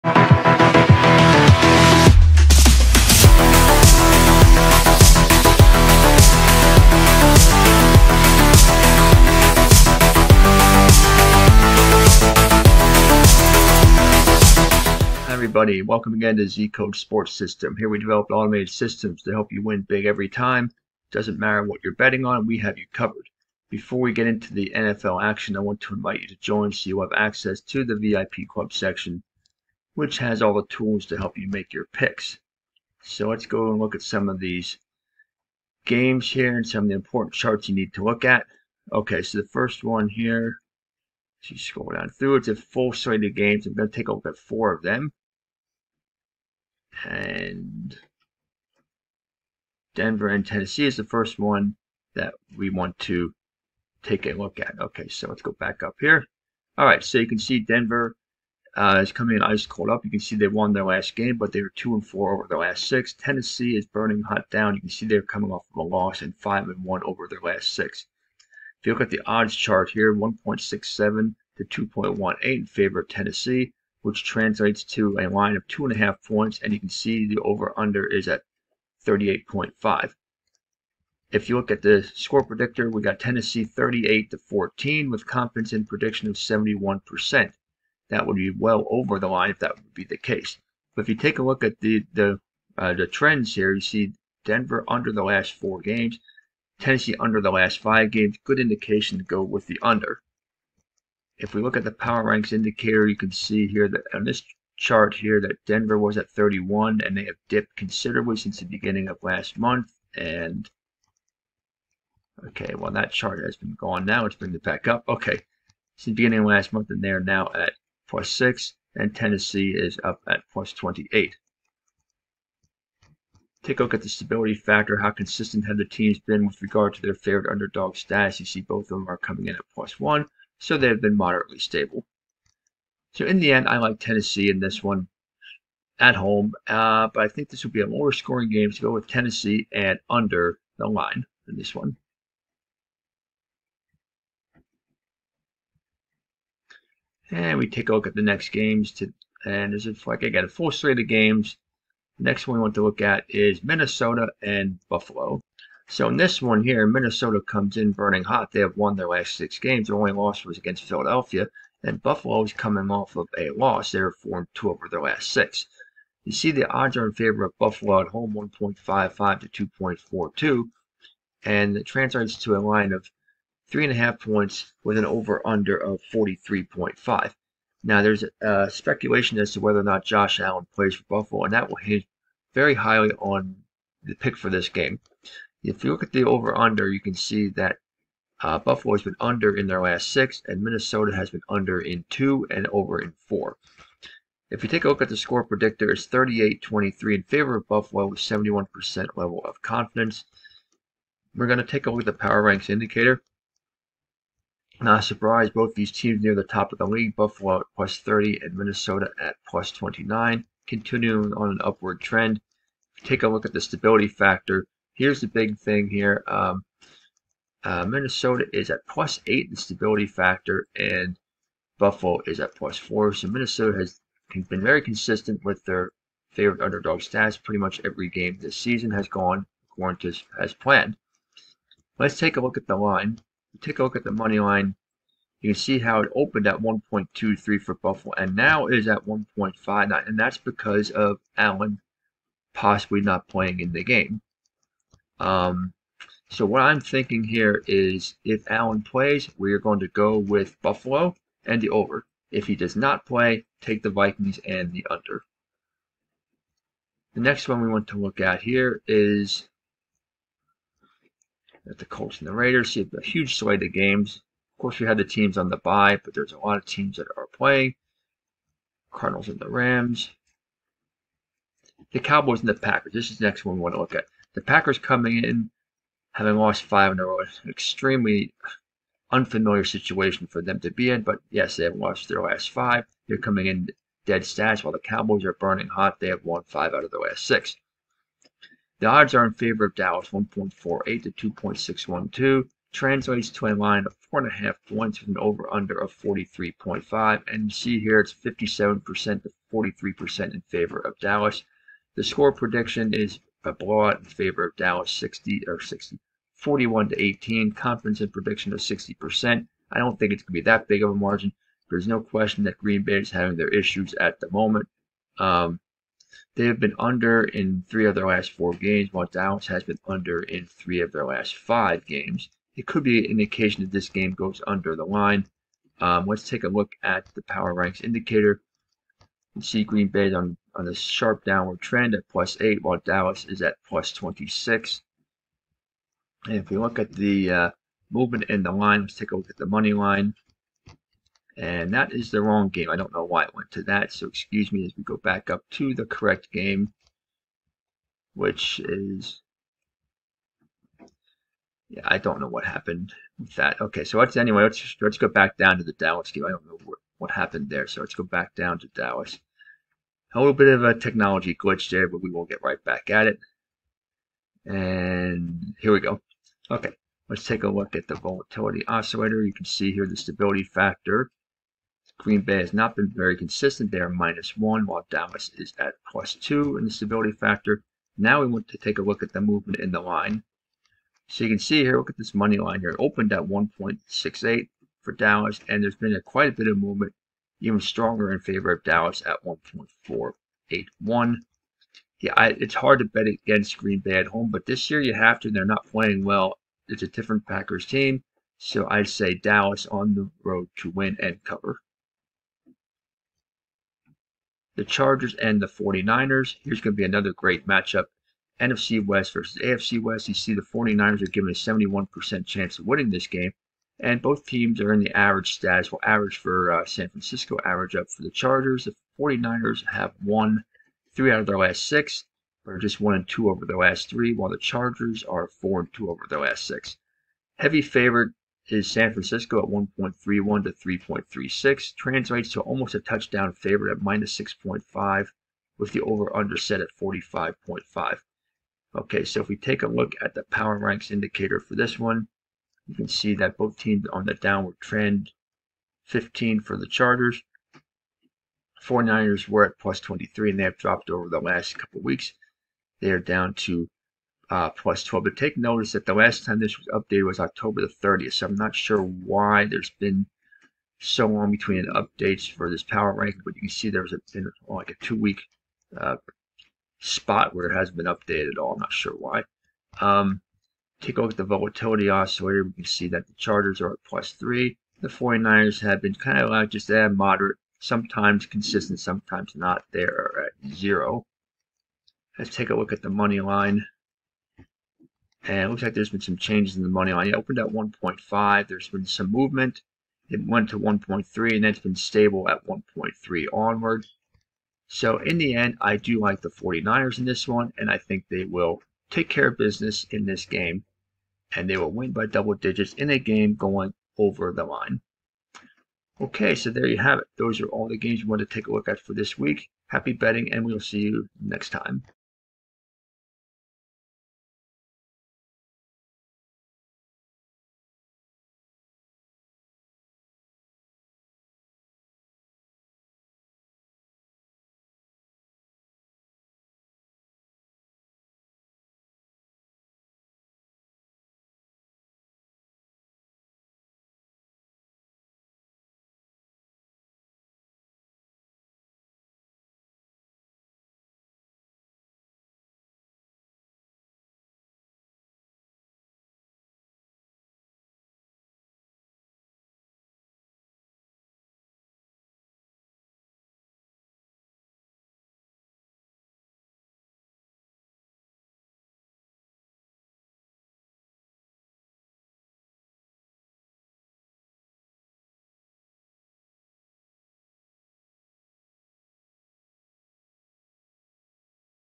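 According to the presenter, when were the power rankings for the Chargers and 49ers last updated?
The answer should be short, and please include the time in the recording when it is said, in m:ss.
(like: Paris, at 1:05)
October 30, at 7:37.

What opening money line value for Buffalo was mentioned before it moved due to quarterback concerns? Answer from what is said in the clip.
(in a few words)
1.23.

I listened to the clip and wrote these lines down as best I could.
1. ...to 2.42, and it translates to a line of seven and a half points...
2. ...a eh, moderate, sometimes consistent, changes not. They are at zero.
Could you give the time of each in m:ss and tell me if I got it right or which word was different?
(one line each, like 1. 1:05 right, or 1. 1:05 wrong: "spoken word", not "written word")
1. 2:49 wrong: "three", not "seven"
2. 7:56 wrong: "sometimes", not "changes".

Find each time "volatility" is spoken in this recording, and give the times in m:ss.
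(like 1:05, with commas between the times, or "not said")
6:07, 7:51.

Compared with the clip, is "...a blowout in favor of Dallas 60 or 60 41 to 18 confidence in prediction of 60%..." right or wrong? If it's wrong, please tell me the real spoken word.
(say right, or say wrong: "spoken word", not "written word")
right.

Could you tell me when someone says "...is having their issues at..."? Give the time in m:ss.
5:12.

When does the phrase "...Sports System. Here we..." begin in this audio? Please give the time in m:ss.
0:16.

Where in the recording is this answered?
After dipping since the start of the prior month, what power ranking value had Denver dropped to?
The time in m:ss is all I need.
1:58.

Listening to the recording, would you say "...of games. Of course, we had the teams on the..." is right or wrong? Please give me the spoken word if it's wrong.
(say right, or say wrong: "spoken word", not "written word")
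right.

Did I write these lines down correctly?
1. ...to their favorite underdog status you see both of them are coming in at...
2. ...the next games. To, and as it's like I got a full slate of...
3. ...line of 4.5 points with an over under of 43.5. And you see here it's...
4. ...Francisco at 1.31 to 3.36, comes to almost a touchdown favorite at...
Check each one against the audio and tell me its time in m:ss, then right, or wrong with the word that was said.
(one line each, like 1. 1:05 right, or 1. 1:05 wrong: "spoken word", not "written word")
1. 2:06 right
2. 2:28 right
3. 4:53 right
4. 7:08 wrong: "translates", not "comes".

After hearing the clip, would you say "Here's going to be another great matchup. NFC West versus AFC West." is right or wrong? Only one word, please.
right.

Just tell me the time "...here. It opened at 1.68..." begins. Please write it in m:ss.
6:22.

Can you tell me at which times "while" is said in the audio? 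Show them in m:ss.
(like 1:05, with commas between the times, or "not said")
4:44, 5:18, 5:32, 6:14, 7:04.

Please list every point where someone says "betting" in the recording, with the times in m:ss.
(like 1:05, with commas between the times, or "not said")
0:21, 8:29.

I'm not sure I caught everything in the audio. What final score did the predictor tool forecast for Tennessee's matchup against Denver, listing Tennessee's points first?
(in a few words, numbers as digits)
38 to 14.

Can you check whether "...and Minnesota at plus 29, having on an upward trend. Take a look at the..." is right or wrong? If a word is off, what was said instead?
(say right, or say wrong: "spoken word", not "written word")
wrong: "continuing", not "having".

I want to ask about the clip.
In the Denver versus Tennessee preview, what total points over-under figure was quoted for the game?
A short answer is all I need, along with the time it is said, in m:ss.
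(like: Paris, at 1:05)
38.5, at 1:19.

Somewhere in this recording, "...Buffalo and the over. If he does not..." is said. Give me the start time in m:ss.
4:10.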